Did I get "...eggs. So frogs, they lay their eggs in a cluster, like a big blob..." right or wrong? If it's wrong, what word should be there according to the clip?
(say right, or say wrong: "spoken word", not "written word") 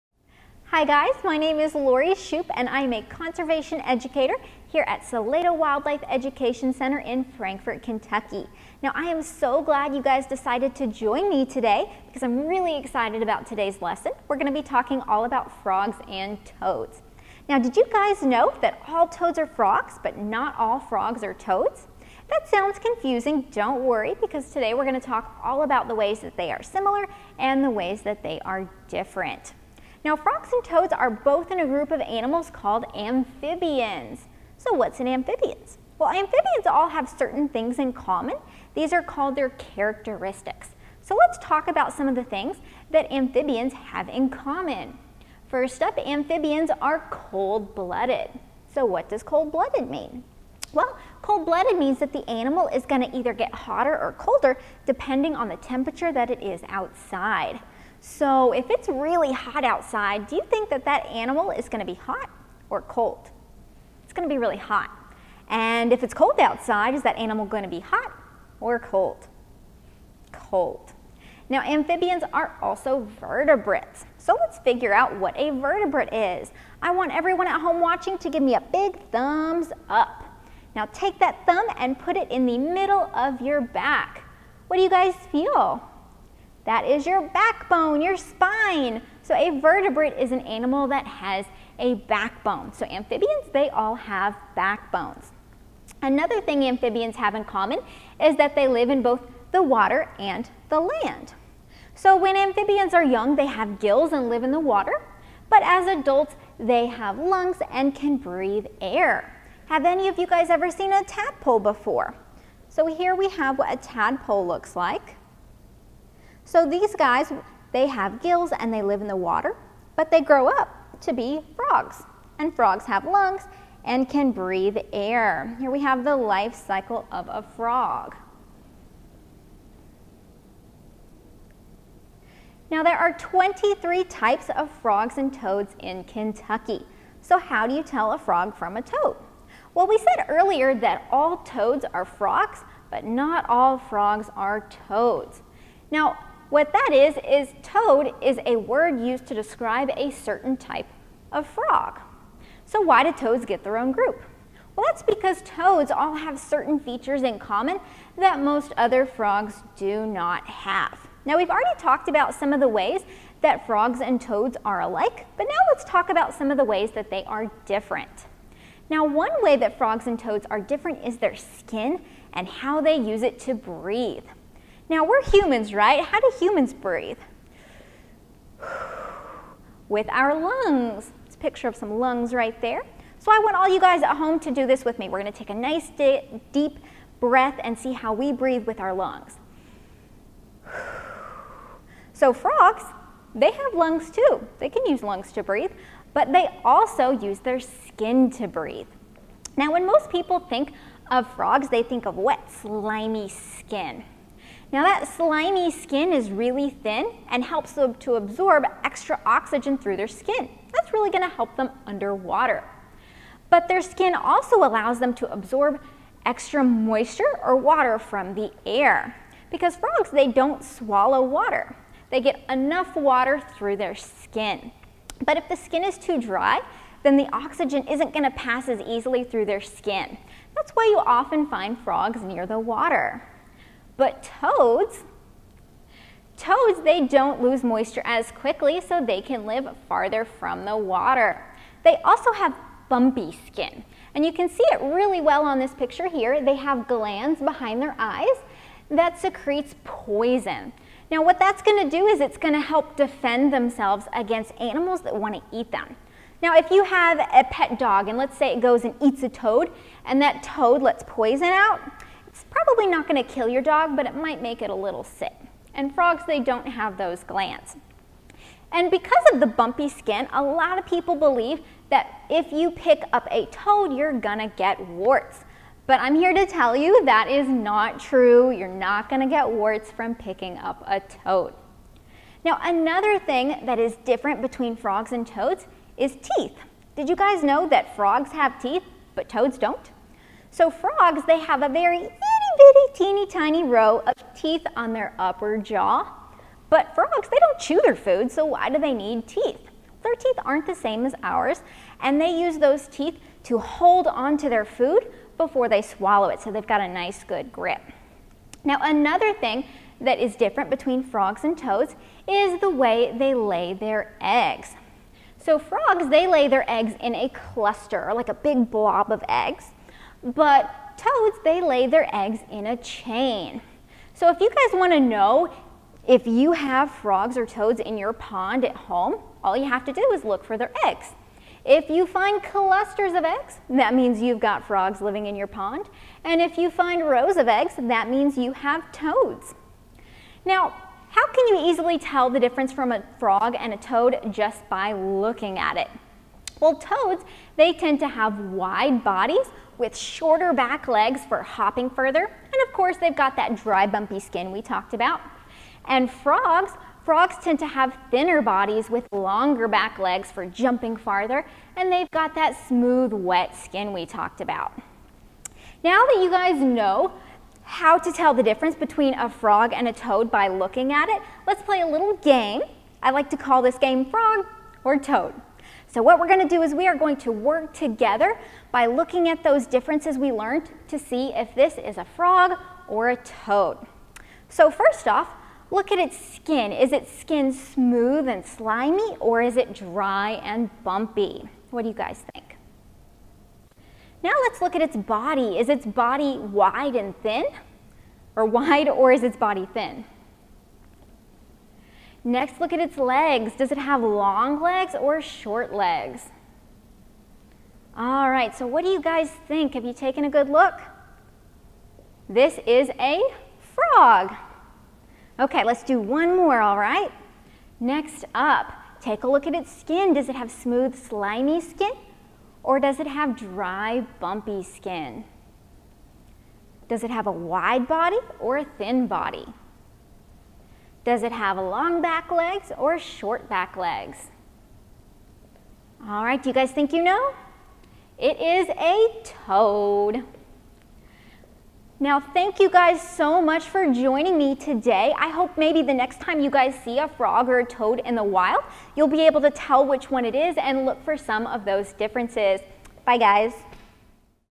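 right.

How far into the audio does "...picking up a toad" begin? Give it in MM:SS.
04:40.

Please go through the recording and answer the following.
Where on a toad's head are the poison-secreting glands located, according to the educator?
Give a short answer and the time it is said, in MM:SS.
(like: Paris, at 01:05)
Behind their eyes, at 04:07.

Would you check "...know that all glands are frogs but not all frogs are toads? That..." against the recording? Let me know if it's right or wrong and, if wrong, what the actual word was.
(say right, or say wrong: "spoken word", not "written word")
wrong: "toads", not "glands".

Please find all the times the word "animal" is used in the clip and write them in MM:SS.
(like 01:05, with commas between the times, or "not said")
00:32, 00:52, 01:01, 01:07, 01:30, 04:14.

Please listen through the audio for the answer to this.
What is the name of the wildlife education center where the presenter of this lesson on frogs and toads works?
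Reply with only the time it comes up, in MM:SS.
00:05.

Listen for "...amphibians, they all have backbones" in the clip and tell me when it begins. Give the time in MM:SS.
01:32.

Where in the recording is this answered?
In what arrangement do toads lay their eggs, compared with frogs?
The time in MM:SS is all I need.
05:22.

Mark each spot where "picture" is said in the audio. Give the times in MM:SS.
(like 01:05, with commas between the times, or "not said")
03:01, 04:05.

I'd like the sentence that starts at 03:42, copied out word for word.
They get enough water through their skin.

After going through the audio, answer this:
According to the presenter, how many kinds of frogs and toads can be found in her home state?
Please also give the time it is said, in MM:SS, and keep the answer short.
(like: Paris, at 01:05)
23, at 02:13.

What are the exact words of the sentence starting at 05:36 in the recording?
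And if you find rows of eggs, that means you have toads.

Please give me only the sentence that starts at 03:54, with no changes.
But toads, toads, they don't lose moisture as quickly, so they can live farther from the water.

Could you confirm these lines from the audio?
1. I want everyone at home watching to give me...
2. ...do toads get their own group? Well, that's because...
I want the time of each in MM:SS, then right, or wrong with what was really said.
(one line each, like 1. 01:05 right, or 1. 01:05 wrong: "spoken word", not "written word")
1. 01:16 right
2. 02:33 right.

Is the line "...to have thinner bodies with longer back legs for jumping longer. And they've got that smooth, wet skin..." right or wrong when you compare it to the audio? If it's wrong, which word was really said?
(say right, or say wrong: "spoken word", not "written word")
wrong: "farther", not "longer".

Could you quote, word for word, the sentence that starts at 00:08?
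Now I am so glad you guys decided to join me today because I'm really excited about today's lesson.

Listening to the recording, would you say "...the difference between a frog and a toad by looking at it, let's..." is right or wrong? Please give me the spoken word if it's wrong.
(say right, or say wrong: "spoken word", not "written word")
right.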